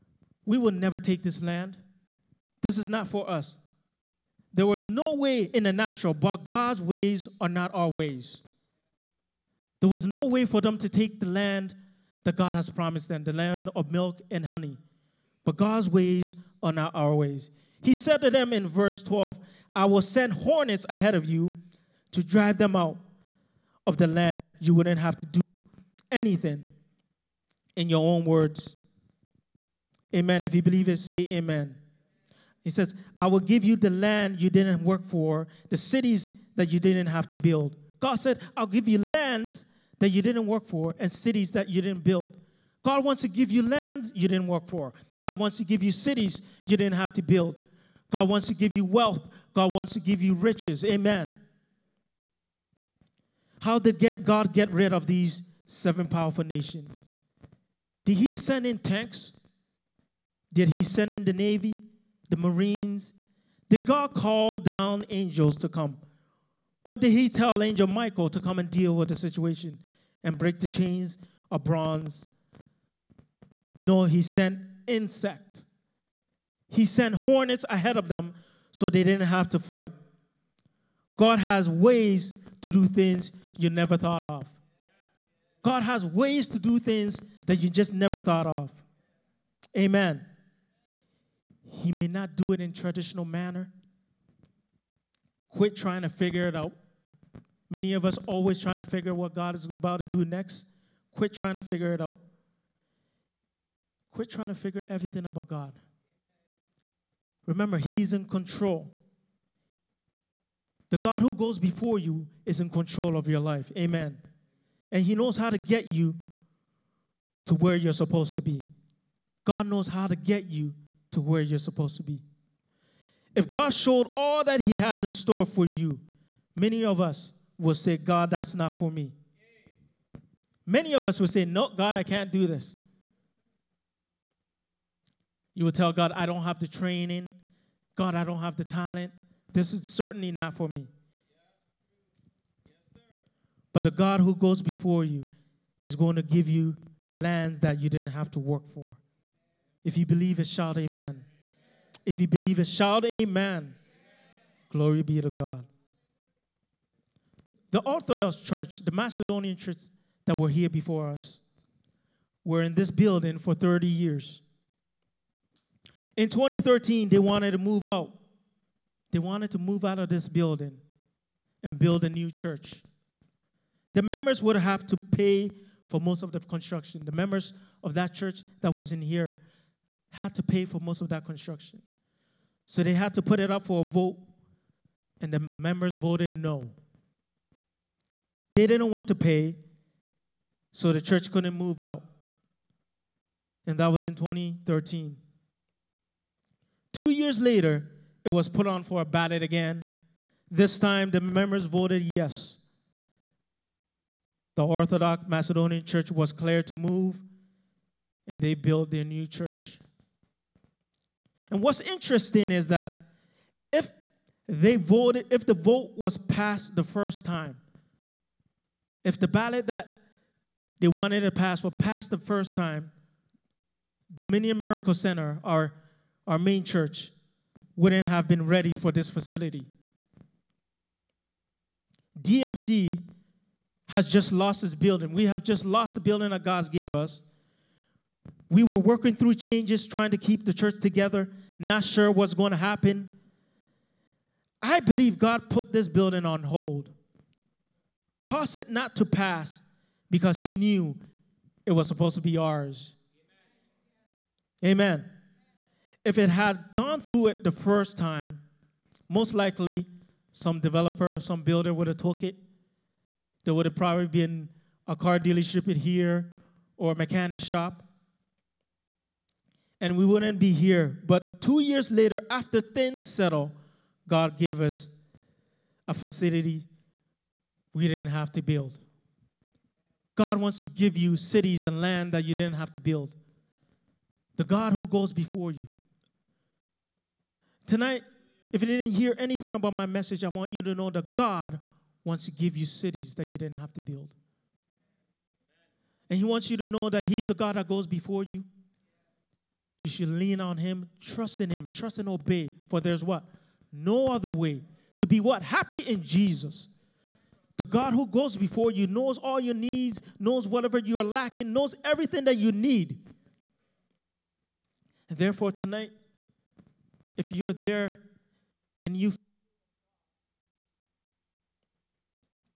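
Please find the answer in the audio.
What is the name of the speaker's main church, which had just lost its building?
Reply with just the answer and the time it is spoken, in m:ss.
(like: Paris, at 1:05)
Dominion Miracle Center, at 3:44.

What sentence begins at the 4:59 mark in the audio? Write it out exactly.
You should lean on Him, trust in Him, trust and obey.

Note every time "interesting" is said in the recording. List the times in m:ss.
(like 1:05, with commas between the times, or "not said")
3:31.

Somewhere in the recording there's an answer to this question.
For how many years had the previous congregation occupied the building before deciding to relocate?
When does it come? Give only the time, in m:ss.
2:43.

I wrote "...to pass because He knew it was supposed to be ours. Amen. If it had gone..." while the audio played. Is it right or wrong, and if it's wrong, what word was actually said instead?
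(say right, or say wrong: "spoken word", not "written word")
right.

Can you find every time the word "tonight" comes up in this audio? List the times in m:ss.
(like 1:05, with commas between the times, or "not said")
4:47, 5:15.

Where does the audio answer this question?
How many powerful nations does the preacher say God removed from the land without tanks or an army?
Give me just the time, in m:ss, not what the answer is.
0:55.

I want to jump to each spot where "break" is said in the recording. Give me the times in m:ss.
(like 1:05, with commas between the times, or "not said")
1:10.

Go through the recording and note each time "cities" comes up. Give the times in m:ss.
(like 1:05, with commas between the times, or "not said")
0:35, 0:41, 0:45, 4:41, 4:52.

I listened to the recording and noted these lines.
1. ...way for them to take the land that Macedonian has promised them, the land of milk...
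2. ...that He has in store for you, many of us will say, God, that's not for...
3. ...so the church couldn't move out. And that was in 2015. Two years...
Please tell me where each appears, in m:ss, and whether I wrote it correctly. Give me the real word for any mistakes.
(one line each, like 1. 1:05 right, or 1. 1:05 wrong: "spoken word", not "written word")
1. 0:10 wrong: "God", not "Macedonian"
2. 2:04 right
3. 3:10 wrong: "2013", not "2015".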